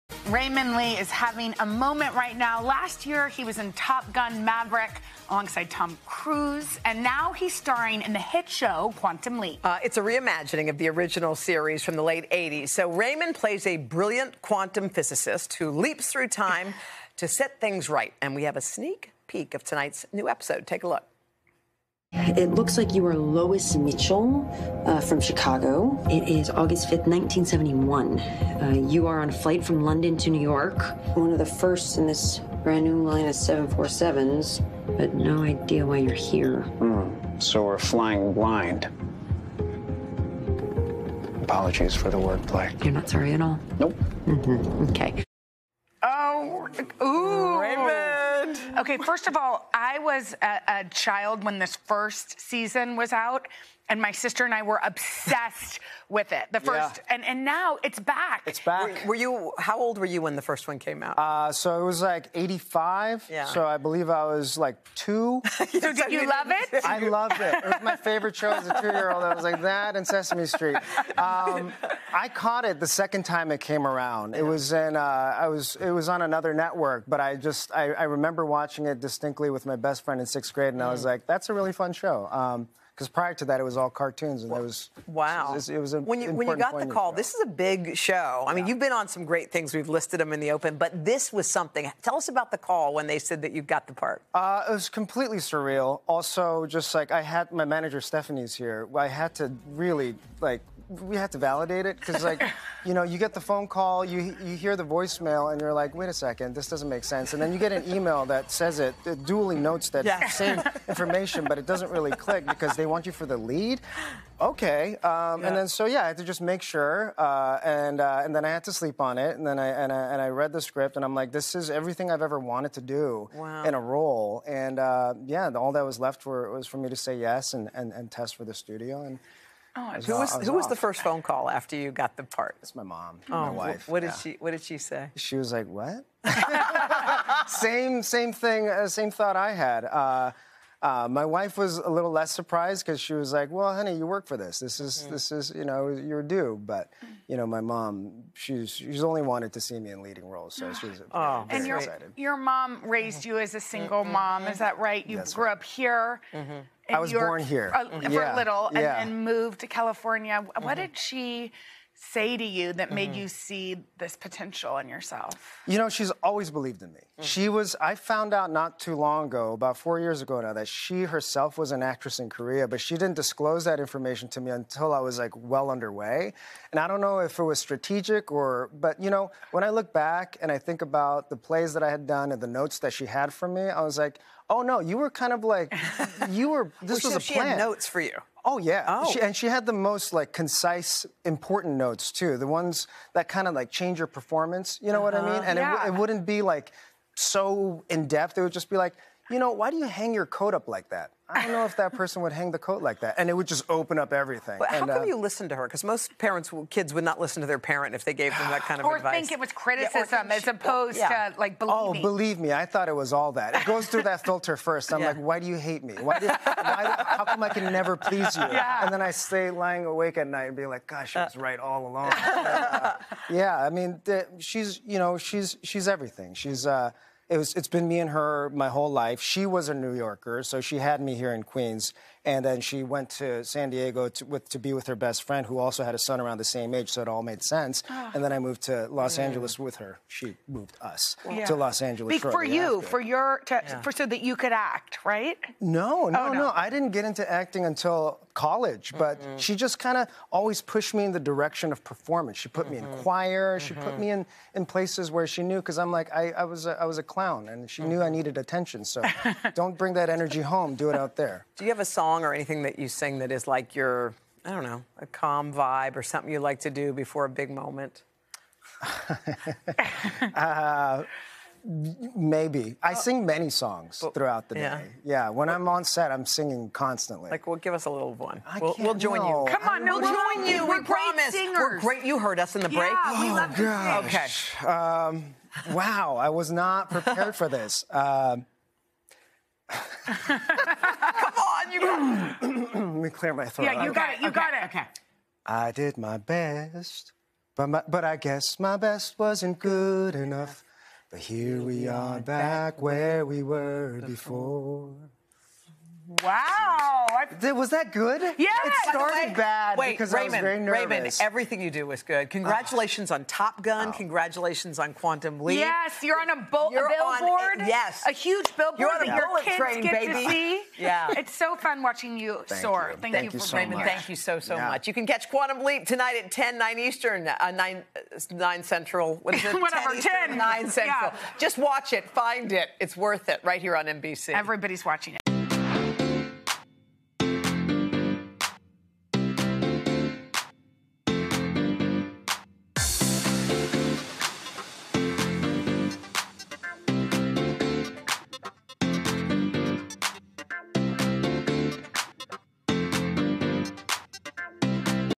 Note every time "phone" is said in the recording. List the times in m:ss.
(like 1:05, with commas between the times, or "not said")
1:43, 2:11.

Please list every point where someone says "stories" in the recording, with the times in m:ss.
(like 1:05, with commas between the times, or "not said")
not said.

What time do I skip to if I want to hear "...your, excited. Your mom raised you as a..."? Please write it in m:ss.
2:31.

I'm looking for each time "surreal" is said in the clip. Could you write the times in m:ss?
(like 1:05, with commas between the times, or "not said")
1:35.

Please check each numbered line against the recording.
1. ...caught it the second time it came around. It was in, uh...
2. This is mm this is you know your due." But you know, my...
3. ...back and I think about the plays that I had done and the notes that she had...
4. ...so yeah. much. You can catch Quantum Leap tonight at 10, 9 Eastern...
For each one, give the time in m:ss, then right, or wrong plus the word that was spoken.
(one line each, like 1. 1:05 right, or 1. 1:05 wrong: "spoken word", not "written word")
1. 1:12 right
2. 2:24 right
3. 2:59 right
4. 5:24 right.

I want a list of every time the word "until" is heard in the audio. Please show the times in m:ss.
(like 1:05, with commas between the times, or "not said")
2:54, 4:07.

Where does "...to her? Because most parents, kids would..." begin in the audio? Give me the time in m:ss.
3:25.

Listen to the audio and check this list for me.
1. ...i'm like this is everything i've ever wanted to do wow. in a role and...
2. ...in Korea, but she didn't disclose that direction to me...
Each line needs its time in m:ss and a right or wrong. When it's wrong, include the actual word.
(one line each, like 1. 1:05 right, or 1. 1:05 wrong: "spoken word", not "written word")
1. 2:01 right
2. 2:52 wrong: "information", not "direction".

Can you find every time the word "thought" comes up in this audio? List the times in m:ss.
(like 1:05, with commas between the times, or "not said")
2:19, 3:32.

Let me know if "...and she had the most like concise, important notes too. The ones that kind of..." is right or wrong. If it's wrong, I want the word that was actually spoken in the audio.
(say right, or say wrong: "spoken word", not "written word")
right.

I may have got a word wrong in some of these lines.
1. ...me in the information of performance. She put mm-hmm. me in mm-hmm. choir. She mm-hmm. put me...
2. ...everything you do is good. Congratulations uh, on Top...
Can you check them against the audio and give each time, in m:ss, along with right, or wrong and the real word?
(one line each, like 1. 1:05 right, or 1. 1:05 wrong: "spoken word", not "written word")
1. 4:10 wrong: "direction", not "information"
2. 5:11 right.